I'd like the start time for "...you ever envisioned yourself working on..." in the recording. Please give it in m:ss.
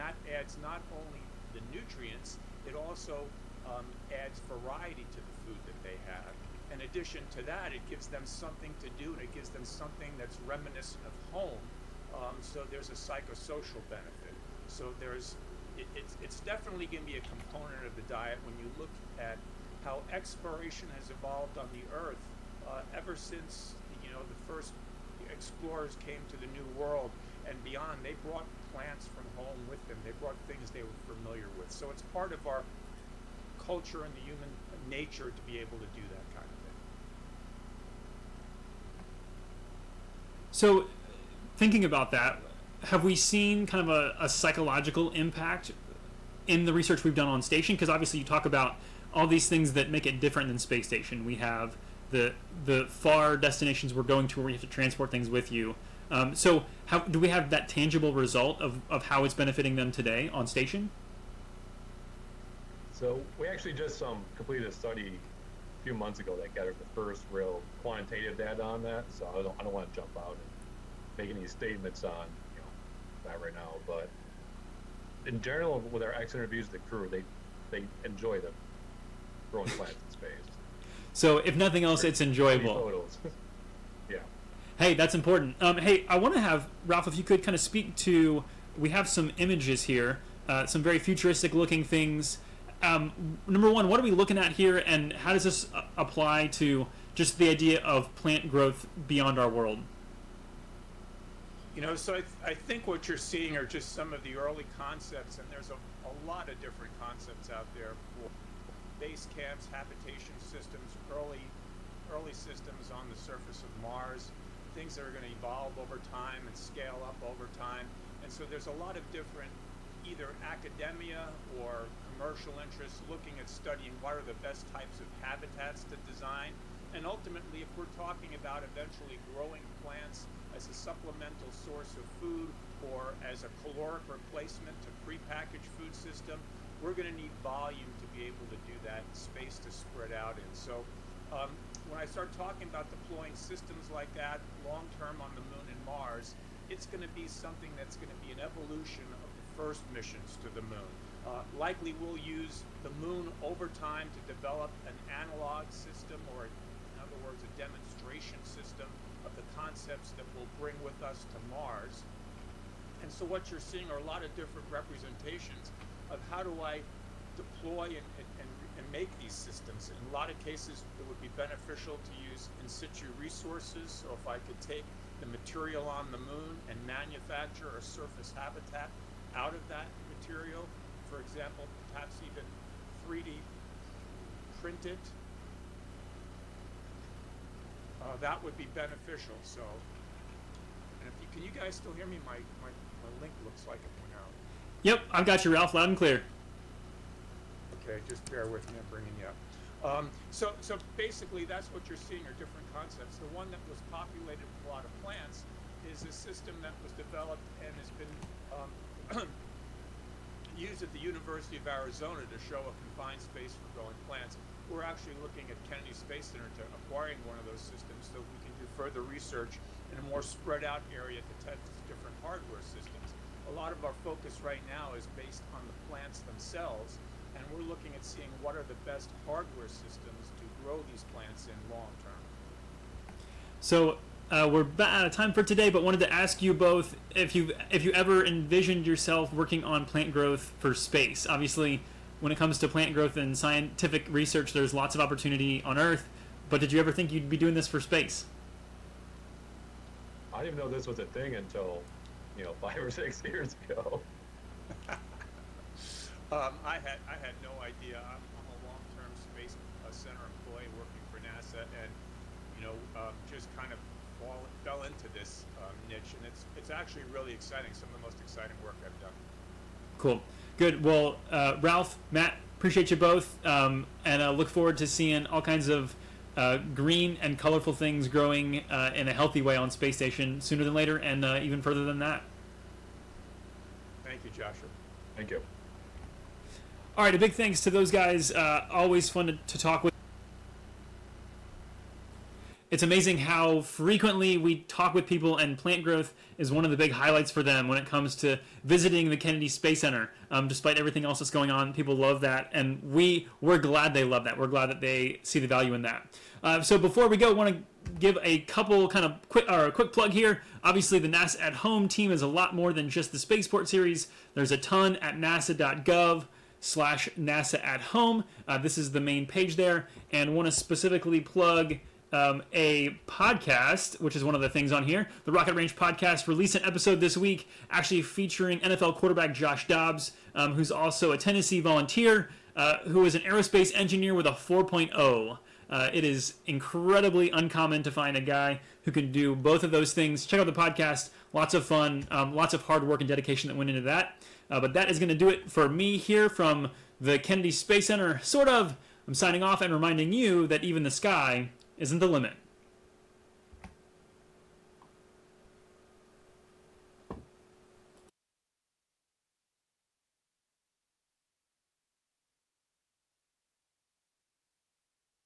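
3:57.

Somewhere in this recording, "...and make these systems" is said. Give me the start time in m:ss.
2:48.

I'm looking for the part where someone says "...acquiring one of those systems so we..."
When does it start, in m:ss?
3:36.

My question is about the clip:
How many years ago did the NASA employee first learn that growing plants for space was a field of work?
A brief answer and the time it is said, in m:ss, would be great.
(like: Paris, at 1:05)
5 or 6, at 4:12.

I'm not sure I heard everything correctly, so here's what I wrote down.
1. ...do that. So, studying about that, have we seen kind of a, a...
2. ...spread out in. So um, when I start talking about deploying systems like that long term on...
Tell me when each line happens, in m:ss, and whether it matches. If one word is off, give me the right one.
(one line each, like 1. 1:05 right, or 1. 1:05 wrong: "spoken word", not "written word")
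1. 0:35 wrong: "thinking", not "studying"
2. 2:19 right.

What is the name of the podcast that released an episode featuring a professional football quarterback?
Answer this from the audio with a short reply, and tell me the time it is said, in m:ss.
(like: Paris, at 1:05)
Rocket Ranch, at 5:25.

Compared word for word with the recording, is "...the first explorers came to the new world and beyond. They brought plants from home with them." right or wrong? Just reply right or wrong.
right.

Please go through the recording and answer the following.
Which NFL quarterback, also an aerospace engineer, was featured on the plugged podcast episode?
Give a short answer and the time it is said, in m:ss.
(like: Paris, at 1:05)
Josh Dobbs, at 5:29.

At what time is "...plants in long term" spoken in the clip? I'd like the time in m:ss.
3:51.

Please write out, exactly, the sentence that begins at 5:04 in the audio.
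We're glad that they see the value in that.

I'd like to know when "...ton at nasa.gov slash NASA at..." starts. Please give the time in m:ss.
5:14.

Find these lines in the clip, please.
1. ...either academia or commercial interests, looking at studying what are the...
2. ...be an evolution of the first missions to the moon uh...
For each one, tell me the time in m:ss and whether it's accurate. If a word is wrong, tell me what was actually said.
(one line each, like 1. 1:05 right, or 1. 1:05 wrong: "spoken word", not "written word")
1. 2:00 right
2. 2:28 right.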